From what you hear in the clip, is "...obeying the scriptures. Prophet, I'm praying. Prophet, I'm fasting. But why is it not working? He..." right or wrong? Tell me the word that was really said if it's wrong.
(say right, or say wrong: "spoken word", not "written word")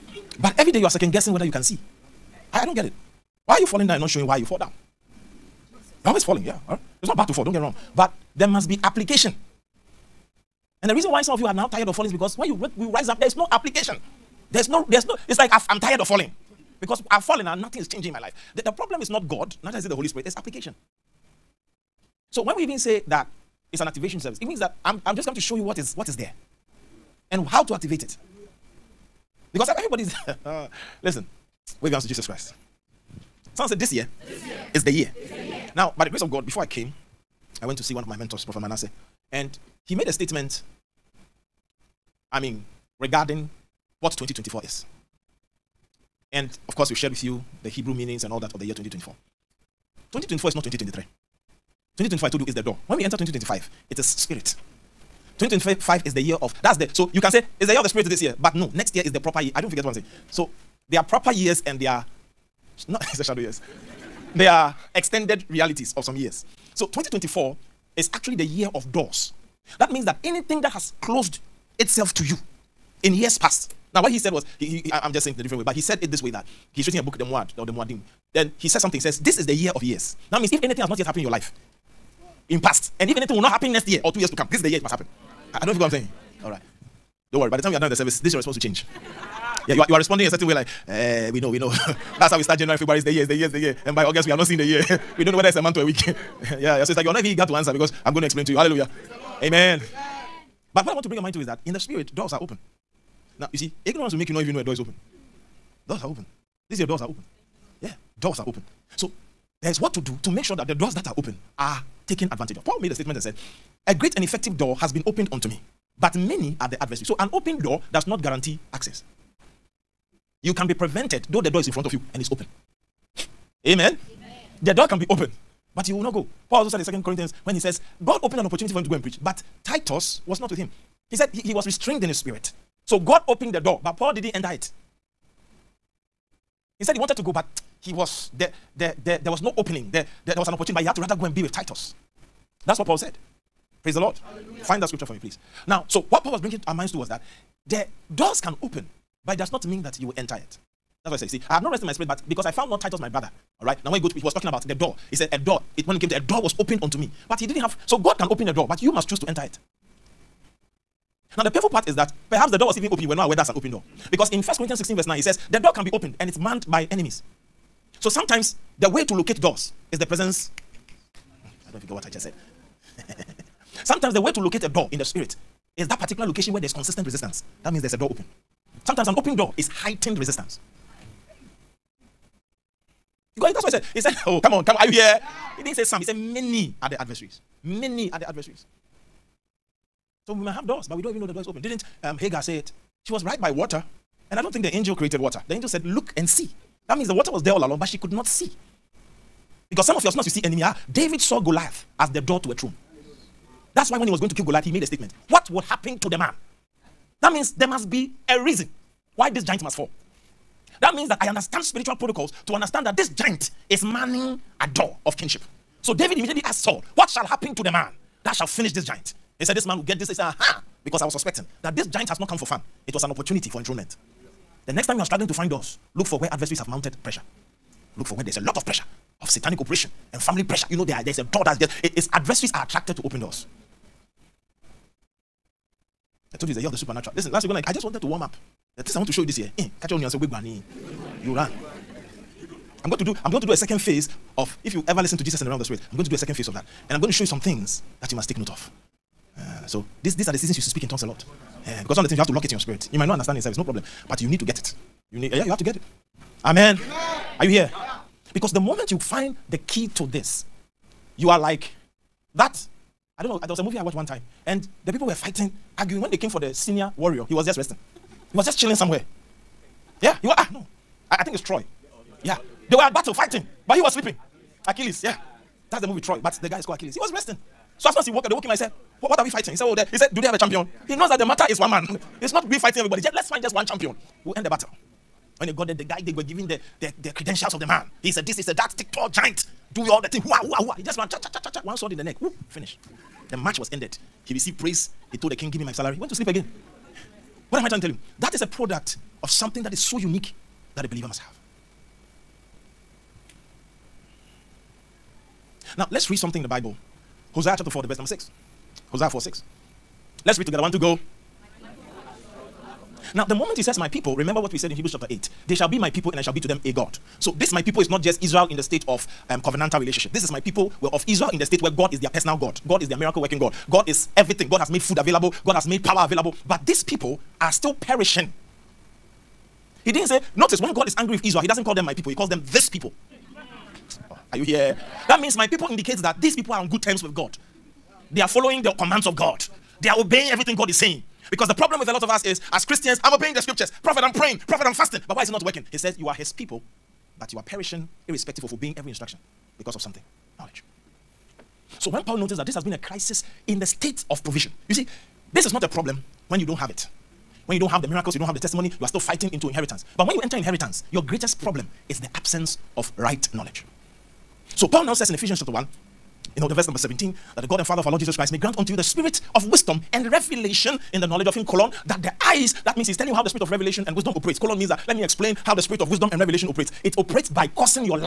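right.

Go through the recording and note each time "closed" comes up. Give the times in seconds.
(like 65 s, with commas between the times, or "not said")
71 s.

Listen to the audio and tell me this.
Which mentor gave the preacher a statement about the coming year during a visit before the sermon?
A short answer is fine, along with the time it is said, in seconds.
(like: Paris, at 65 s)
Prophet Manasseh, at 38 s.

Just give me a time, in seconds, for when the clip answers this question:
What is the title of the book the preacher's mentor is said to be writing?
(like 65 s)
77 s.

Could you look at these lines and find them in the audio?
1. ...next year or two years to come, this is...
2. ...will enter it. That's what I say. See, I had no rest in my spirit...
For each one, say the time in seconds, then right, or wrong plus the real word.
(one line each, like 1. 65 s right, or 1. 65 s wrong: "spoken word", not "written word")
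1. 83 s right
2. 150 s right.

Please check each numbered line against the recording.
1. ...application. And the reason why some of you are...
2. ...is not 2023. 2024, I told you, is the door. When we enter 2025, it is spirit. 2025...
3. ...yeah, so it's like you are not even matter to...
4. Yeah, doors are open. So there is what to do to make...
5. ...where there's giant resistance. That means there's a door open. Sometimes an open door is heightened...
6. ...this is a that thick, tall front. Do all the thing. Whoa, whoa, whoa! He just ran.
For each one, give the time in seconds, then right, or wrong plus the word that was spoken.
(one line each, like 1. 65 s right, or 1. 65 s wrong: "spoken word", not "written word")
1. 8 s right
2. 50 s right
3. 96 s wrong: "eager", not "matter"
4. 107 s right
5. 176 s wrong: "consistent", not "giant"
6. 288 s wrong: "giant", not "front".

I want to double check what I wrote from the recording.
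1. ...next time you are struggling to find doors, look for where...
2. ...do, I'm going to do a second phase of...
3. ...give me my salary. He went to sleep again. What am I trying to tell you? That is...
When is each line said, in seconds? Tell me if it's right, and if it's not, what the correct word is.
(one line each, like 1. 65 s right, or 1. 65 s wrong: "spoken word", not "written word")
1. 224 s right
2. 243 s right
3. 295 s right.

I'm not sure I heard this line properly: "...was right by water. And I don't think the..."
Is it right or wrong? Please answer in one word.
right.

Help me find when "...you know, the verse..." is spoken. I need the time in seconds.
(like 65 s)
366 s.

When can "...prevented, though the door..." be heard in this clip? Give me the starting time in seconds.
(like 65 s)
120 s.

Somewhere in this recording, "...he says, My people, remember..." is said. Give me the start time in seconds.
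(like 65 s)
313 s.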